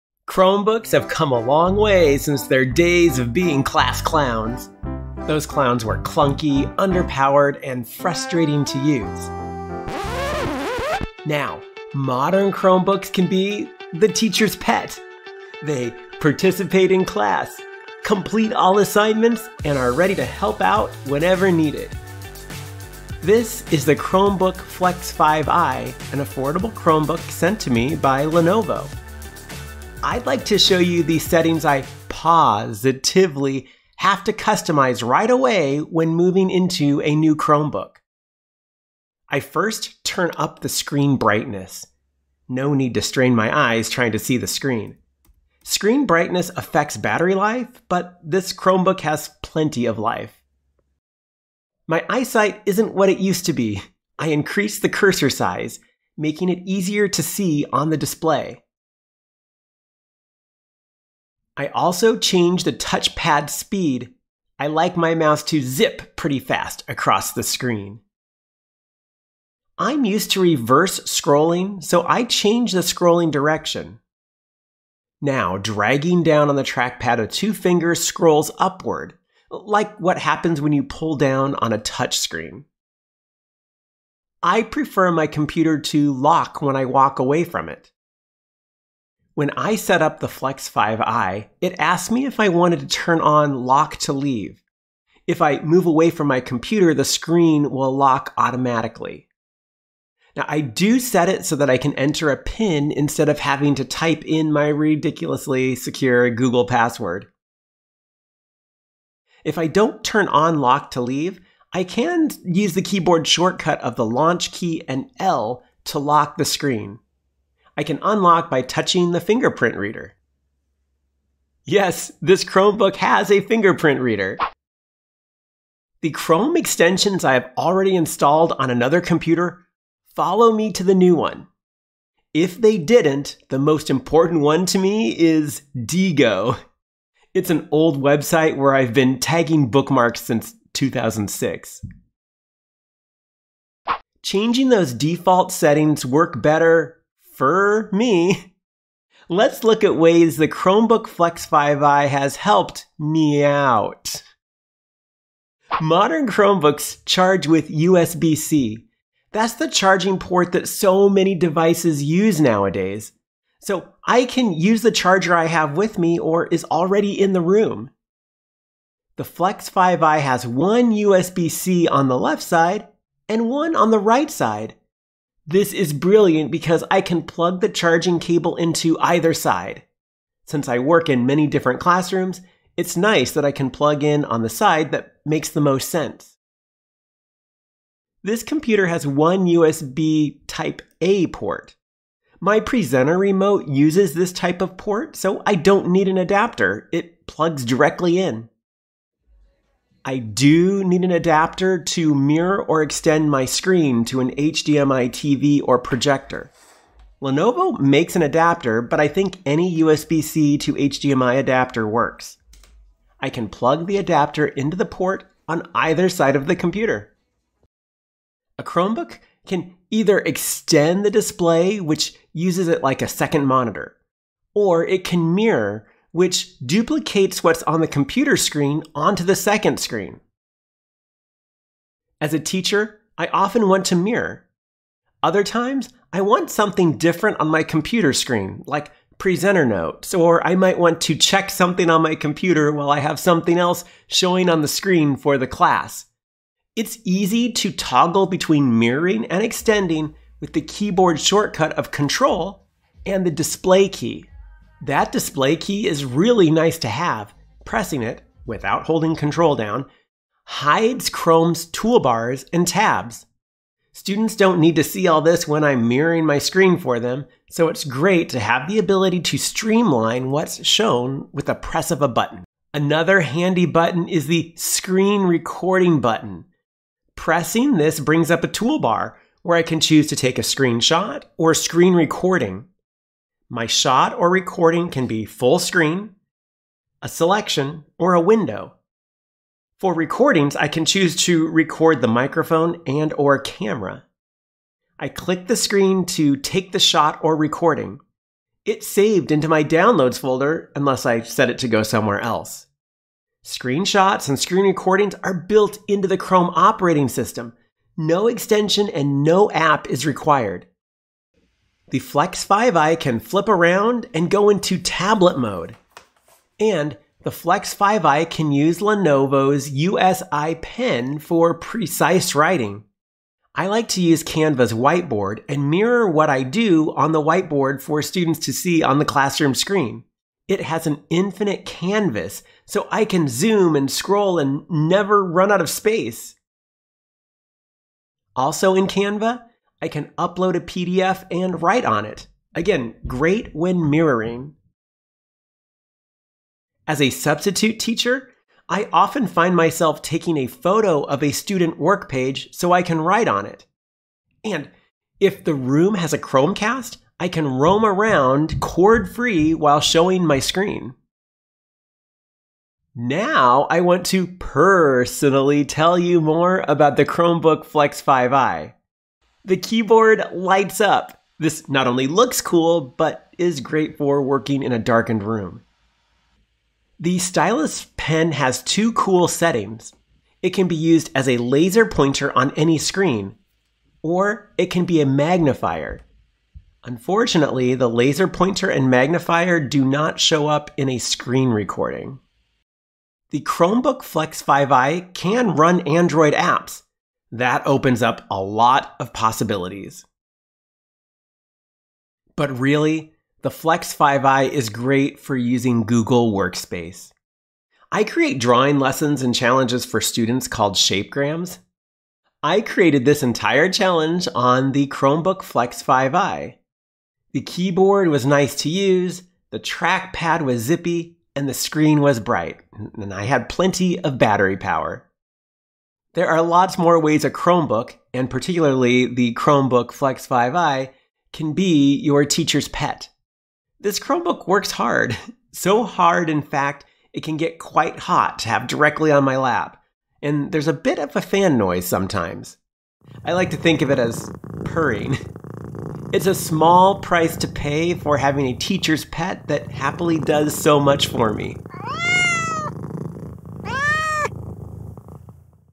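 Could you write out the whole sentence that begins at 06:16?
The stylus pen has two cool settings.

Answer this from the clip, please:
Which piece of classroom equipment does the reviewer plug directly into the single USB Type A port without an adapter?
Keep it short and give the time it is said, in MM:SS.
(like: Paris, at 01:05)
presenter remote, at 03:12.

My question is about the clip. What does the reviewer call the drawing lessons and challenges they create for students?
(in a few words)
Shapegrams.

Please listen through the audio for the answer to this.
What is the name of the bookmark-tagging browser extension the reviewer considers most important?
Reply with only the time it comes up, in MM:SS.
02:15.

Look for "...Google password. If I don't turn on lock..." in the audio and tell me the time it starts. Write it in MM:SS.
01:46.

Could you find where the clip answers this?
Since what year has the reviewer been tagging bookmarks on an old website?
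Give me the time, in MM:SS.
02:20.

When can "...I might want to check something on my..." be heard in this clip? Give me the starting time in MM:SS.
04:00.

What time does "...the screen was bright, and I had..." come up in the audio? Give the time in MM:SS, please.
07:01.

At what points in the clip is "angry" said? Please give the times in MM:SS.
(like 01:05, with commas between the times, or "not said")
not said.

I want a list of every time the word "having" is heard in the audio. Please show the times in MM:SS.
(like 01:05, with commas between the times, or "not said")
01:43, 07:28.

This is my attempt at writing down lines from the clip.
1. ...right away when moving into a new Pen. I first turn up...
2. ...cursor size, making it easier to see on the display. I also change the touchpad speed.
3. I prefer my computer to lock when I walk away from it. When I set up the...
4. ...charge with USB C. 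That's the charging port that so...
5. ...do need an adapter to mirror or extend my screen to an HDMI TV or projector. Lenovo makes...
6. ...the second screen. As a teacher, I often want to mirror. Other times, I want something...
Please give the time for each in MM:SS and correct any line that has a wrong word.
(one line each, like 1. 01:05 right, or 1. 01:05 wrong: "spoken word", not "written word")
1. 00:35 wrong: "Chromebook", not "Pen"
2. 00:54 right
3. 01:24 right
4. 02:37 right
5. 03:20 right
6. 03:49 right.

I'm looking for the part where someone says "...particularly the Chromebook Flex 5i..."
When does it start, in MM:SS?
07:08.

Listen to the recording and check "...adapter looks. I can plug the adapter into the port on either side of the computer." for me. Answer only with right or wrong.
wrong.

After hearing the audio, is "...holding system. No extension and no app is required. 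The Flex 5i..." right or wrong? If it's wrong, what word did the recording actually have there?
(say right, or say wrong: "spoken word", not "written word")
wrong: "operating", not "holding".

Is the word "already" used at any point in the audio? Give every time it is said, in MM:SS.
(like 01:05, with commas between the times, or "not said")
02:07, 02:46.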